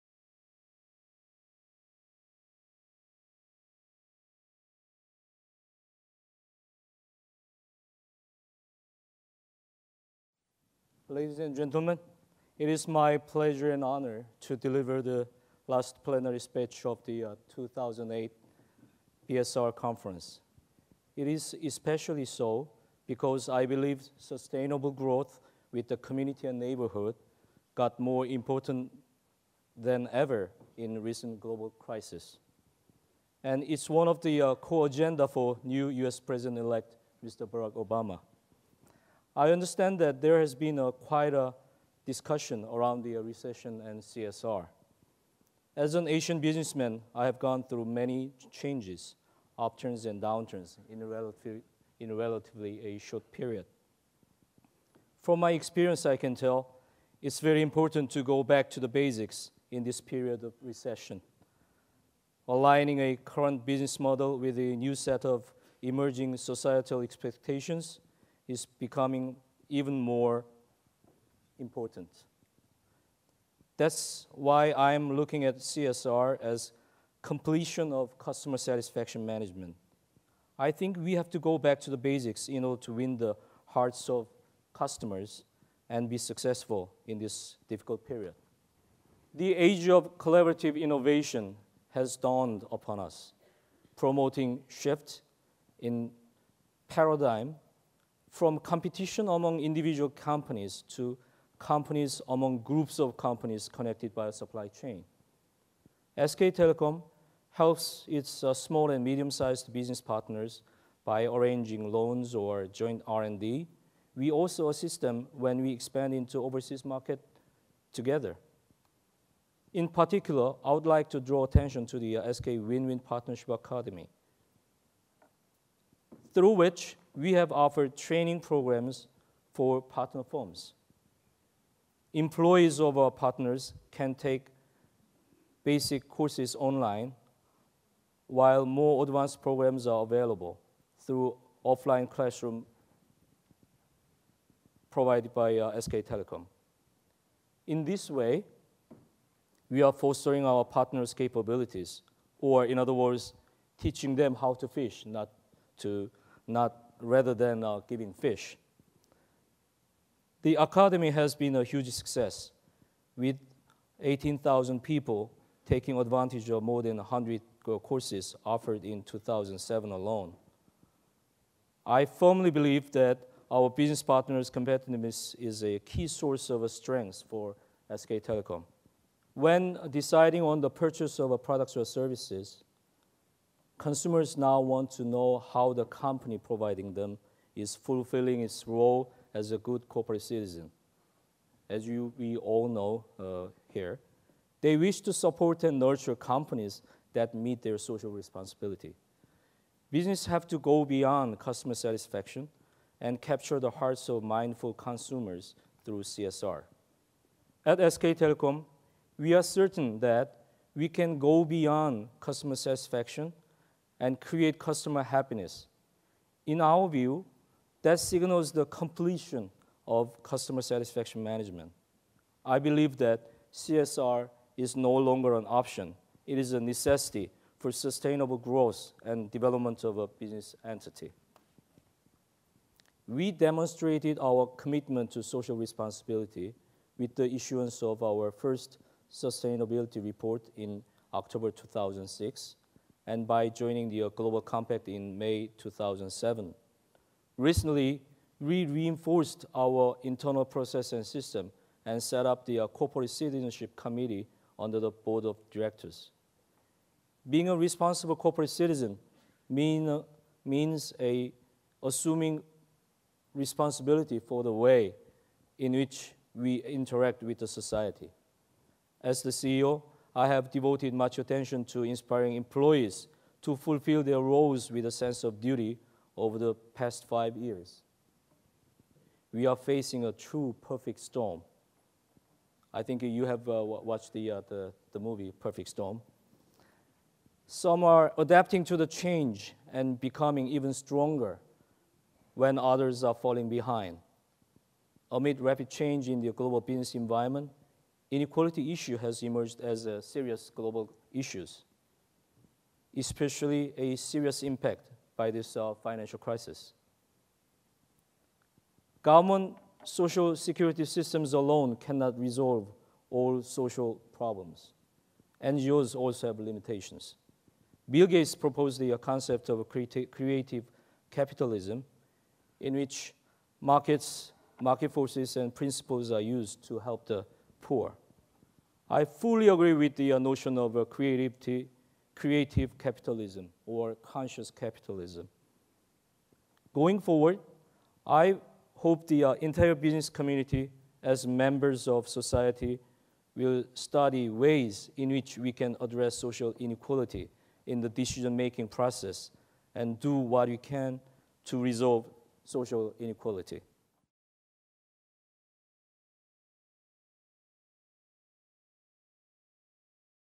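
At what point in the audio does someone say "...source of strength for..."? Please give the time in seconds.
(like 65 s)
176 s.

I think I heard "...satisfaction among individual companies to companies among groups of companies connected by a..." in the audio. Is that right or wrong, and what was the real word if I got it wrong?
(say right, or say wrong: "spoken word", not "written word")
wrong: "competition", not "satisfaction".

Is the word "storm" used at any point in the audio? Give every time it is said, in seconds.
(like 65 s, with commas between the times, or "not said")
280 s, 285 s.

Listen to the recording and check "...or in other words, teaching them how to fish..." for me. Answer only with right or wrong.
right.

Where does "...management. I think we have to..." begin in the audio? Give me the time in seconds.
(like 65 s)
79 s.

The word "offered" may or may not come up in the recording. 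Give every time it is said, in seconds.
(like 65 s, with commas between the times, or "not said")
127 s, 168 s.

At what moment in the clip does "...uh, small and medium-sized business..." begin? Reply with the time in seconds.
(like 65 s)
108 s.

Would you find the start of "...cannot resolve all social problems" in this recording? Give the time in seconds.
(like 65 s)
311 s.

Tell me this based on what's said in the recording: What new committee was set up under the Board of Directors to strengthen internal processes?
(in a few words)
Corporate Citizenship Committee.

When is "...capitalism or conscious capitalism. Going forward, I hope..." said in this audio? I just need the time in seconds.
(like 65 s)
332 s.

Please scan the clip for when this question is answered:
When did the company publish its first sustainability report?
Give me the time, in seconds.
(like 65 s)
241 s.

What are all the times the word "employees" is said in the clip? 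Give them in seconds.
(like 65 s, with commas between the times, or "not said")
132 s, 272 s.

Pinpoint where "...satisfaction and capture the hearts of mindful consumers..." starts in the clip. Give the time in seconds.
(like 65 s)
201 s.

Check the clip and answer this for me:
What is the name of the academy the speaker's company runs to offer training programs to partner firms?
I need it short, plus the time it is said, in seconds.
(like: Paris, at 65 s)
SK Win-Win Partnership Academy, at 122 s.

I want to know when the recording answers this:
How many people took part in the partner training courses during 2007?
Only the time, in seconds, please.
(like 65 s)
164 s.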